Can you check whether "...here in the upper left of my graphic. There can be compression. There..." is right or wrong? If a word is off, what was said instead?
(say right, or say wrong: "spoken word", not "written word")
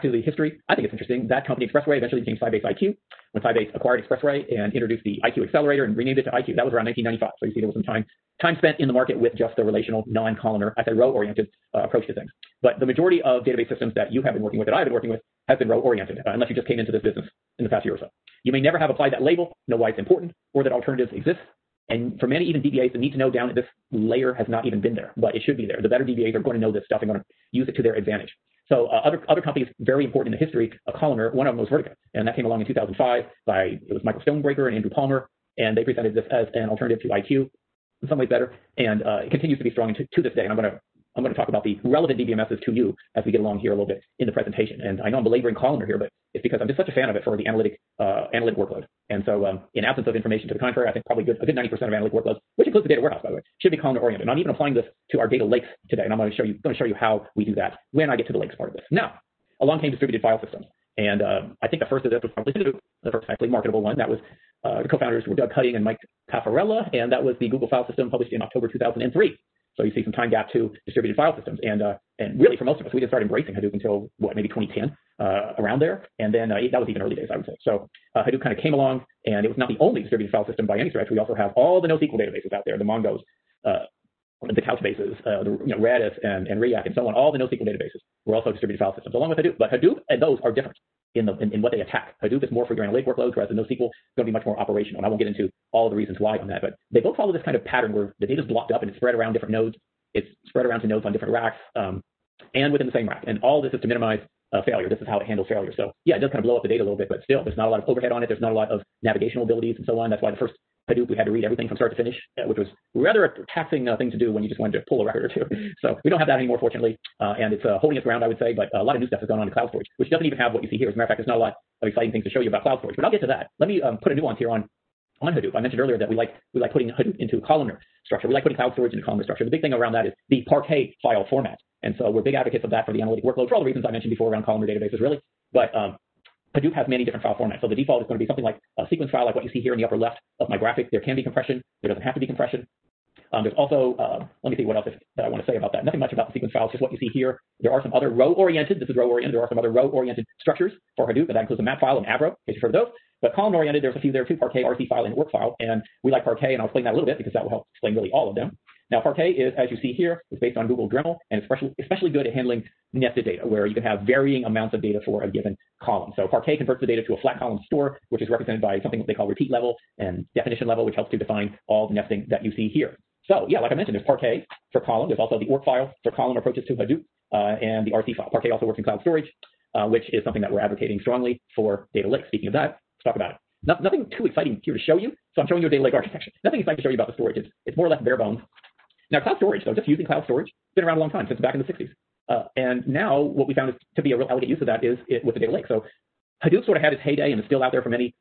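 right.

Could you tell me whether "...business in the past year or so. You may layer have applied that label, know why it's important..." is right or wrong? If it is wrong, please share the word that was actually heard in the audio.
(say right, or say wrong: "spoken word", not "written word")
wrong: "never", not "layer".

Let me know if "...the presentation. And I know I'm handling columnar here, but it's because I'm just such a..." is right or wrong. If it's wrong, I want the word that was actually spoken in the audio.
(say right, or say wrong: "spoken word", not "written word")
wrong: "belaboring", not "handling".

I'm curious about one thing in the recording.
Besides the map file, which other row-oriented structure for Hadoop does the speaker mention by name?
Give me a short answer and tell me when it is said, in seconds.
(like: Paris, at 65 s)
Avro, at 152 s.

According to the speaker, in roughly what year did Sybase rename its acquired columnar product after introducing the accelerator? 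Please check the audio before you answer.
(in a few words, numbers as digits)
1995.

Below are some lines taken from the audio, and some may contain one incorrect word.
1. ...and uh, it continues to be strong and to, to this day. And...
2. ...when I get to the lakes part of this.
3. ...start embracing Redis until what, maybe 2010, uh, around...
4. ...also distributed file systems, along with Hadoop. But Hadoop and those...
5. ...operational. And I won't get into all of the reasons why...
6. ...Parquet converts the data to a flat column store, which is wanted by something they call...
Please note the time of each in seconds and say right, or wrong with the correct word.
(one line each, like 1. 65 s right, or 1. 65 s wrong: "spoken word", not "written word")
1. 38 s right
2. 57 s right
3. 73 s wrong: "Hadoop", not "Redis"
4. 88 s right
5. 94 s right
6. 166 s wrong: "represented", not "wanted".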